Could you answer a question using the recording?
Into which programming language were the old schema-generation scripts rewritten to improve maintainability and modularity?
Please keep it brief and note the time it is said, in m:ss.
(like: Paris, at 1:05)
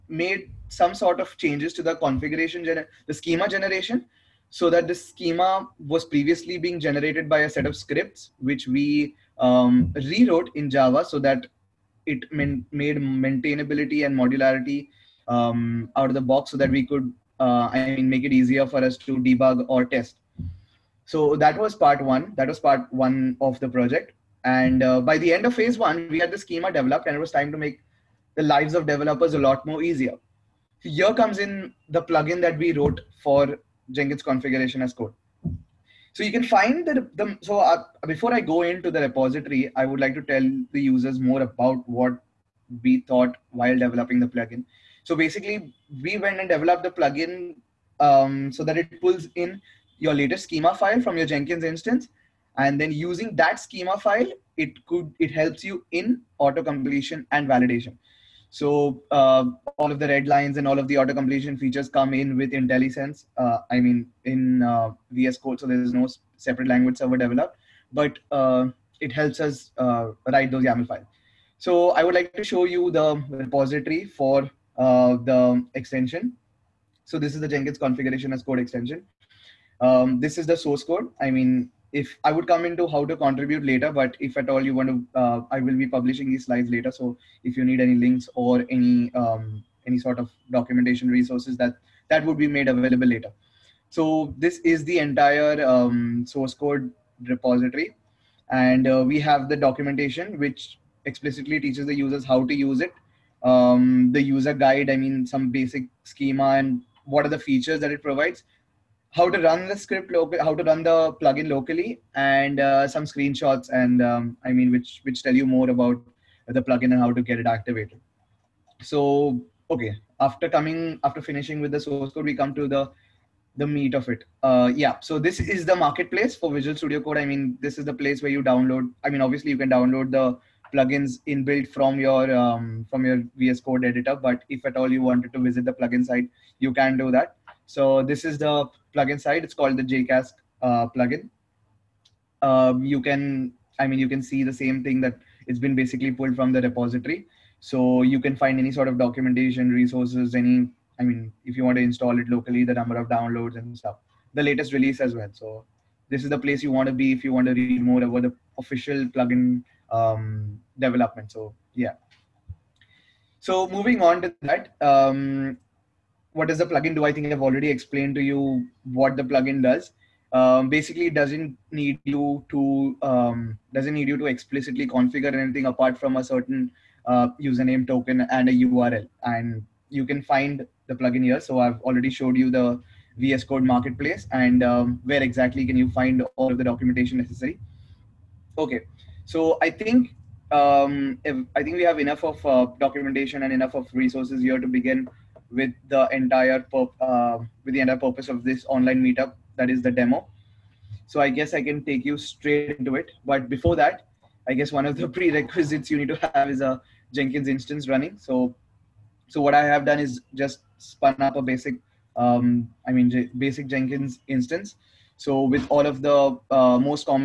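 Java, at 0:10.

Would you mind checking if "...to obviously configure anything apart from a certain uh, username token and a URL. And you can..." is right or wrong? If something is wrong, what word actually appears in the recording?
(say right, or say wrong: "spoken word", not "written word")
wrong: "explicitly", not "obviously".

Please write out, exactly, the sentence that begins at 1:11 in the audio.
So I would like to show you the repository for uh, the extension.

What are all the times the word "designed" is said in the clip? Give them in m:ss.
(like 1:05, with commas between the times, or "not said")
not said.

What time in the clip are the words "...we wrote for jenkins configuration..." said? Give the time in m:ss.
0:32.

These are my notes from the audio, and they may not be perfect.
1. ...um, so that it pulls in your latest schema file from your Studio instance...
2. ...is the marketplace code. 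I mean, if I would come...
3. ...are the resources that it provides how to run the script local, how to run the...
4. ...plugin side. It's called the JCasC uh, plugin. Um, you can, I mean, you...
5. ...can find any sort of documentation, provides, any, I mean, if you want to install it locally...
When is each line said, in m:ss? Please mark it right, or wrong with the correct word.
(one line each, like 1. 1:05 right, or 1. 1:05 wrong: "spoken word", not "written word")
1. 0:47 wrong: "Jenkins", not "Studio"
2. 1:20 wrong: "source", not "marketplace"
3. 1:47 wrong: "features", not "resources"
4. 2:18 right
5. 2:28 wrong: "resources", not "provides".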